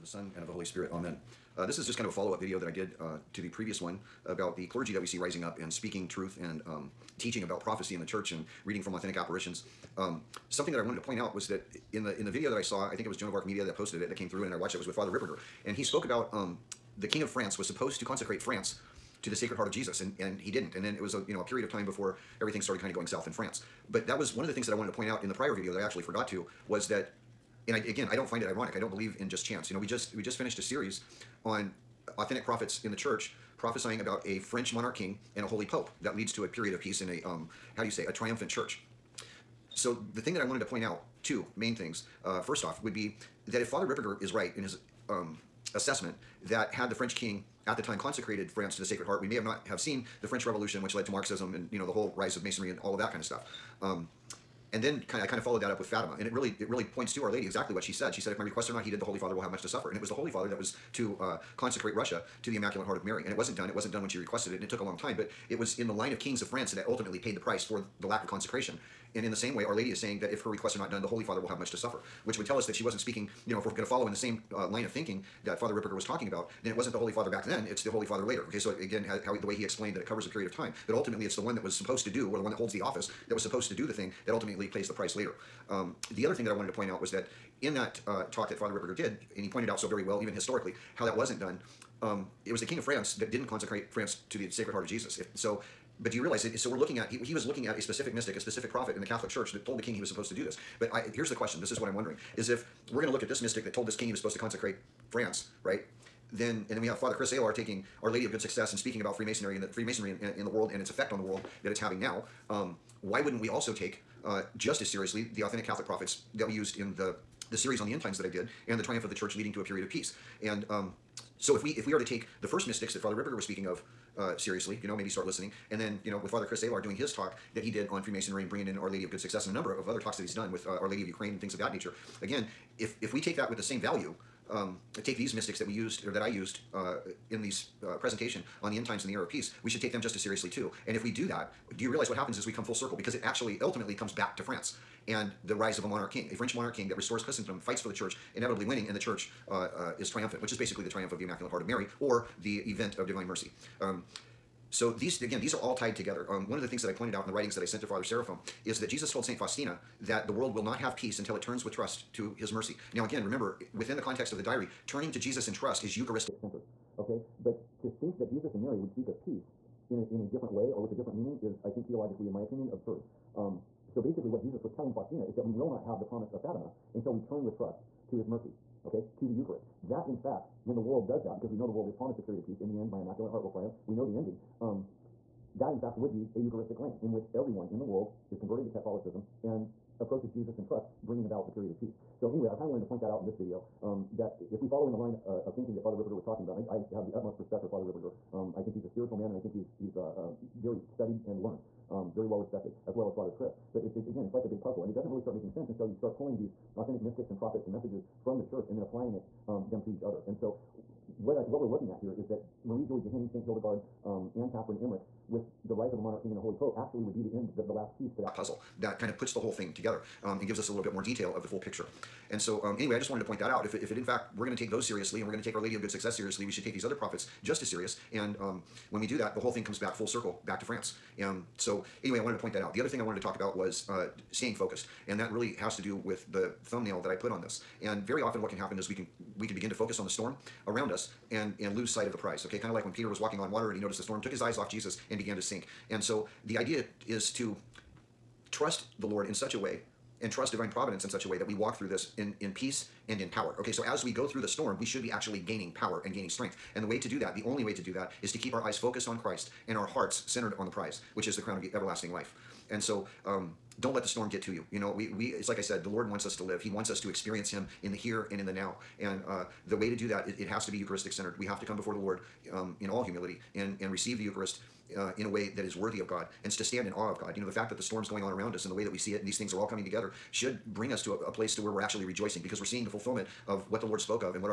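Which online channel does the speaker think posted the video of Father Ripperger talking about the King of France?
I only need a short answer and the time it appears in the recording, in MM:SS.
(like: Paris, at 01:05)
Joan of Arc Media, at 00:13.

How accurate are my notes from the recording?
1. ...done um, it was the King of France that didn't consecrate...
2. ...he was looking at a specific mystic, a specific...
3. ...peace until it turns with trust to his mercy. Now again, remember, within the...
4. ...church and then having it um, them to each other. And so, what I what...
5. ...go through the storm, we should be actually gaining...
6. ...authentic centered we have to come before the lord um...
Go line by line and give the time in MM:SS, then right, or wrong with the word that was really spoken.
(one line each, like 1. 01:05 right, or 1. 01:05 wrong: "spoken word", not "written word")
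1. 01:31 right
2. 01:37 right
3. 02:40 right
4. 03:28 wrong: "applying", not "having"
5. 04:14 right
6. 04:30 wrong: "eucharistic", not "authentic".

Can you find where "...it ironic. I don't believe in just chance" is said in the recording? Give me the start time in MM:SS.
00:28.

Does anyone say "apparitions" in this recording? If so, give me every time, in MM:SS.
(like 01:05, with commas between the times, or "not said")
00:09.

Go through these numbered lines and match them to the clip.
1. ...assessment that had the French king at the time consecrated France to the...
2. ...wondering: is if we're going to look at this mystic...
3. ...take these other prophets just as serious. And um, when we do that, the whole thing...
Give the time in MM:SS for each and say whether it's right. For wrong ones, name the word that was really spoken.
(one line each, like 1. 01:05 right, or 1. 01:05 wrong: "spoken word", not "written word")
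1. 00:45 right
2. 01:41 right
3. 03:46 right.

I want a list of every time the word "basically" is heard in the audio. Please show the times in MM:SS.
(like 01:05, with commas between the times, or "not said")
02:30, 02:54.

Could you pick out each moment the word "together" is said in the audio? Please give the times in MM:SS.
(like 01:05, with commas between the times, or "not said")
02:35, 03:39, 04:39.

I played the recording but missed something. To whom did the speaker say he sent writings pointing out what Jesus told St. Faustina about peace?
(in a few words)
Father Seraphim.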